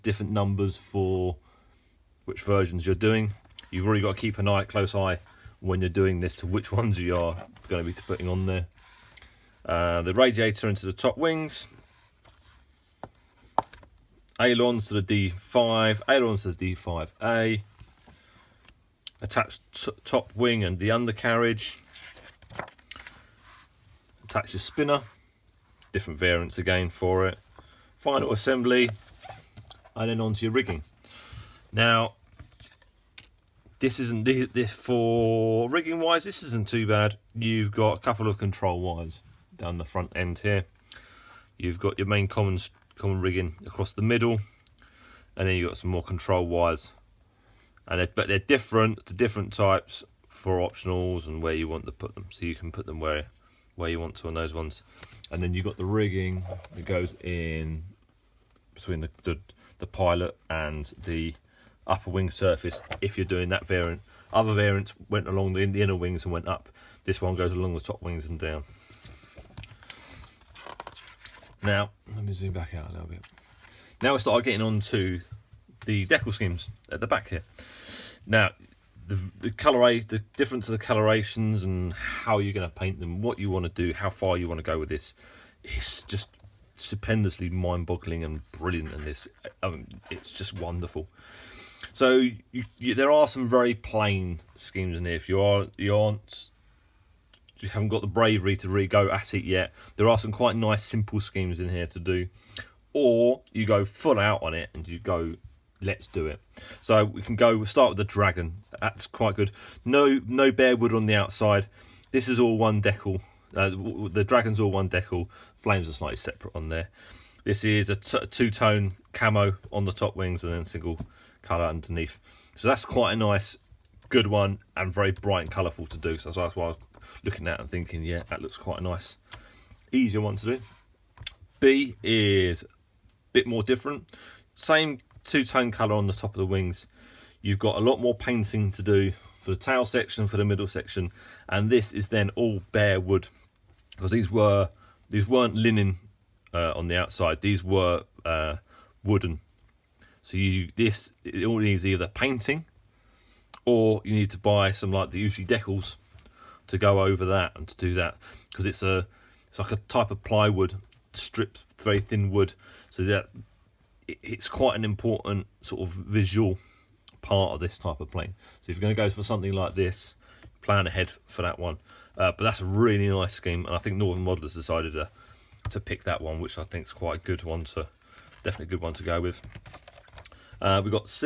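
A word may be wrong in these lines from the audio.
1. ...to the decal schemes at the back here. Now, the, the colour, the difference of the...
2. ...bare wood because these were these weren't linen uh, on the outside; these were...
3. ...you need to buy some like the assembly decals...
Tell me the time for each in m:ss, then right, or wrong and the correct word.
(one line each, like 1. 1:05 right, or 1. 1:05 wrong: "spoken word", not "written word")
1. 1:14 right
2. 2:22 right
3. 2:34 wrong: "usually", not "assembly".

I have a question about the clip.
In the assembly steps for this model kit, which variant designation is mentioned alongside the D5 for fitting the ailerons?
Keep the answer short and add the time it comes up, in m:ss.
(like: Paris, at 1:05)
D5A, at 0:16.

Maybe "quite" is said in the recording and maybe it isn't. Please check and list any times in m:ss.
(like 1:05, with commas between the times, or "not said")
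1:40, 1:49, 2:02, 2:08, 2:44, 2:56.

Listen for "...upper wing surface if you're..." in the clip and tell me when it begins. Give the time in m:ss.
1:01.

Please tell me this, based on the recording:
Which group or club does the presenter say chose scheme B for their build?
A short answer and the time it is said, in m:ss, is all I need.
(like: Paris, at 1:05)
Northern Modelers, at 2:53.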